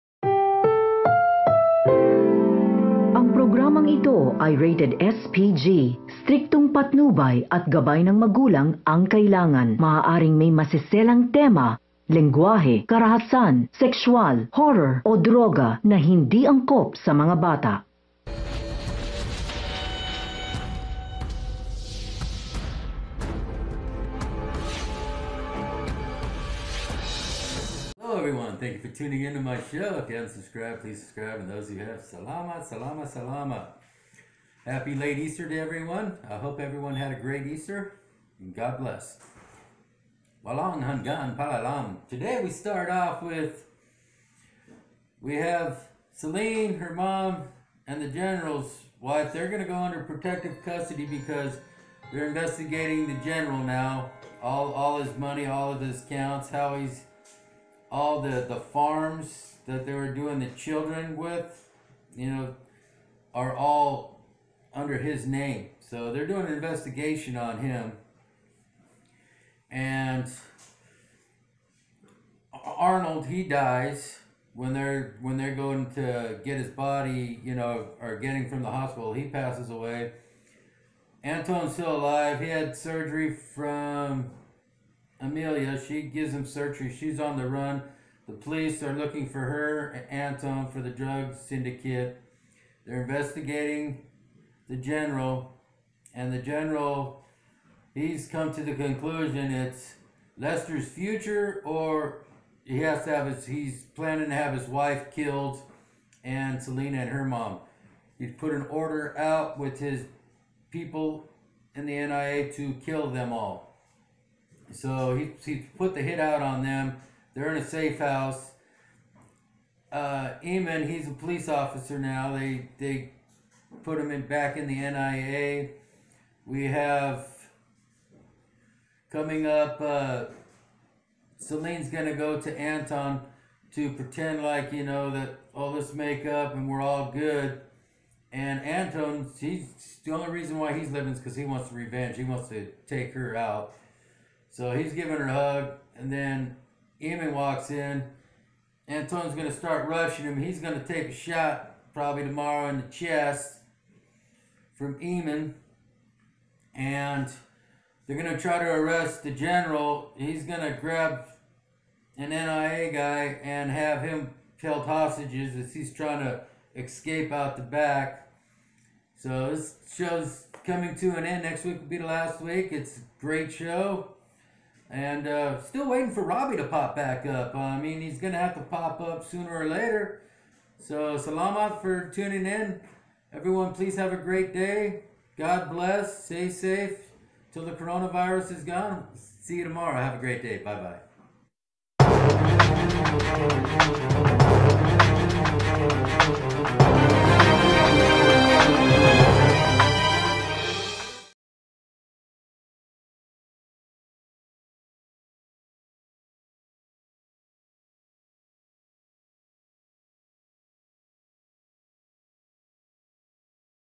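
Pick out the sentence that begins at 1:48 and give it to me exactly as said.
He's put an order out with his people in the NIA to kill them all.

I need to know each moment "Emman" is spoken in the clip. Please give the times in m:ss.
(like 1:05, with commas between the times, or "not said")
2:00, 2:27, 2:34.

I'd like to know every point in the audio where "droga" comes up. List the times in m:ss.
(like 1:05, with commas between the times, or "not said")
0:15.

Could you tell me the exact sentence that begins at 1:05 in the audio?
So they're doing an investigation on him.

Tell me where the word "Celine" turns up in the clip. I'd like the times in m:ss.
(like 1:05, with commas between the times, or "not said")
0:46, 2:11.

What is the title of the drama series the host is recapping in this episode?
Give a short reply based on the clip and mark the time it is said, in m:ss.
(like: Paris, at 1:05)
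Walang Hanggang Paalam, at 0:40.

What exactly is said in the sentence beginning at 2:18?
And Anton, he's the only reason why he's living is because he wants revenge.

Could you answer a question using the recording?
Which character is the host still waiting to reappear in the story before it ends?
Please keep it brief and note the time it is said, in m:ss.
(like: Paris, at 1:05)
Robbie, at 2:56.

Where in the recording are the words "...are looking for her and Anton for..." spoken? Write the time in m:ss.
1:28.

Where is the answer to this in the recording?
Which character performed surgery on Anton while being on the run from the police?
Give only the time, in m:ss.
1:25.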